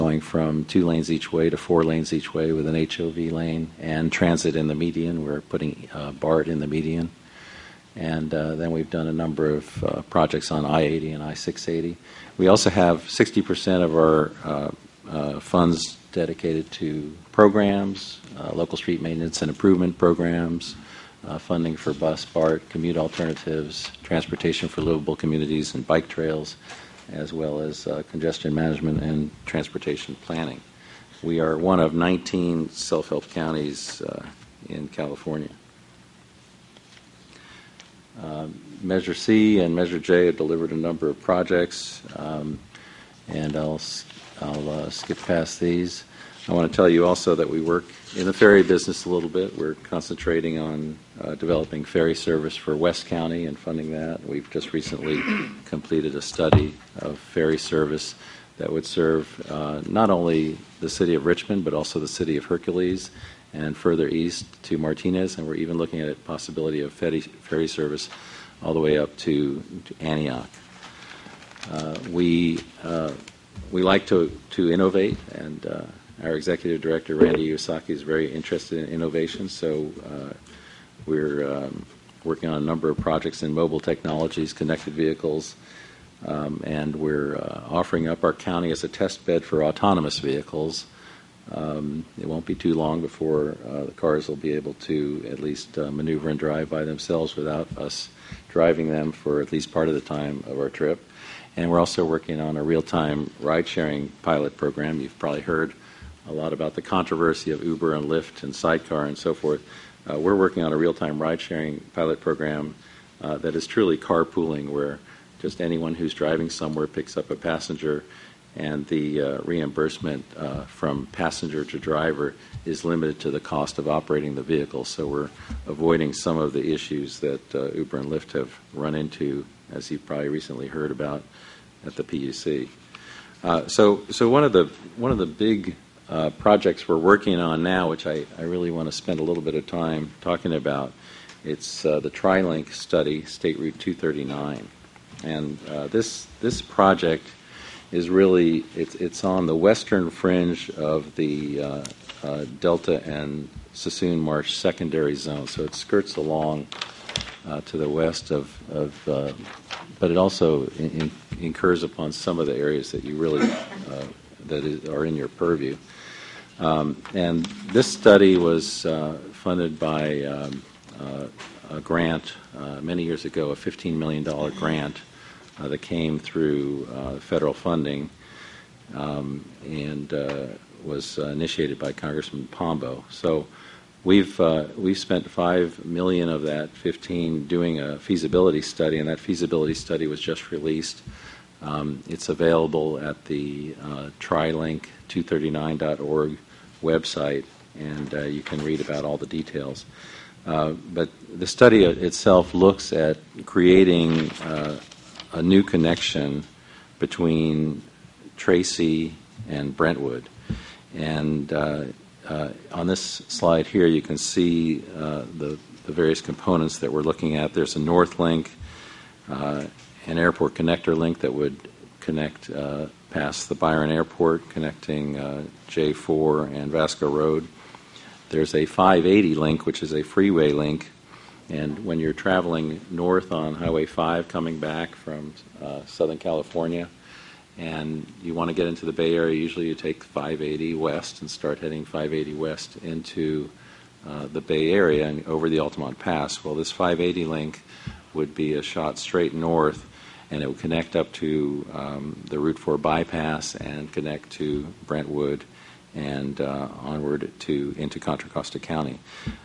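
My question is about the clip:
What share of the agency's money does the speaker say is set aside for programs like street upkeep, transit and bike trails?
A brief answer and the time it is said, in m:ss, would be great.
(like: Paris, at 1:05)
60%, at 0:13.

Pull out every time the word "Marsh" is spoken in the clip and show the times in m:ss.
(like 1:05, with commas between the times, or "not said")
2:34.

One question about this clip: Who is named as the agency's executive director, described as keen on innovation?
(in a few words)
Randy Iwasaki.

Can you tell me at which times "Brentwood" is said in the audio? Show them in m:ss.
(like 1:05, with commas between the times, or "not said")
3:29, 4:14.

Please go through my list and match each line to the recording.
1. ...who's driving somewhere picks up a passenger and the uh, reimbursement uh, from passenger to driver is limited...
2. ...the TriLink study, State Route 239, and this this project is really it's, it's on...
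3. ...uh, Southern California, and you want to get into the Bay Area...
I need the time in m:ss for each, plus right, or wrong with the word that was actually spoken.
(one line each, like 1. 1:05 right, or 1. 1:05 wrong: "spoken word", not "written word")
1. 1:55 right
2. 2:21 right
3. 3:55 right.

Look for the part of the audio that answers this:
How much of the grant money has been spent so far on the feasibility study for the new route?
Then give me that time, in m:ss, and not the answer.
3:05.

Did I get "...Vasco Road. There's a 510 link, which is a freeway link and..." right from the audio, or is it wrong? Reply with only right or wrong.
wrong.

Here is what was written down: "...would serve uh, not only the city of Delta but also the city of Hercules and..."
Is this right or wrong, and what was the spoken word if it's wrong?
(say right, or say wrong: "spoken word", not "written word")
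wrong: "Richmond", not "Delta".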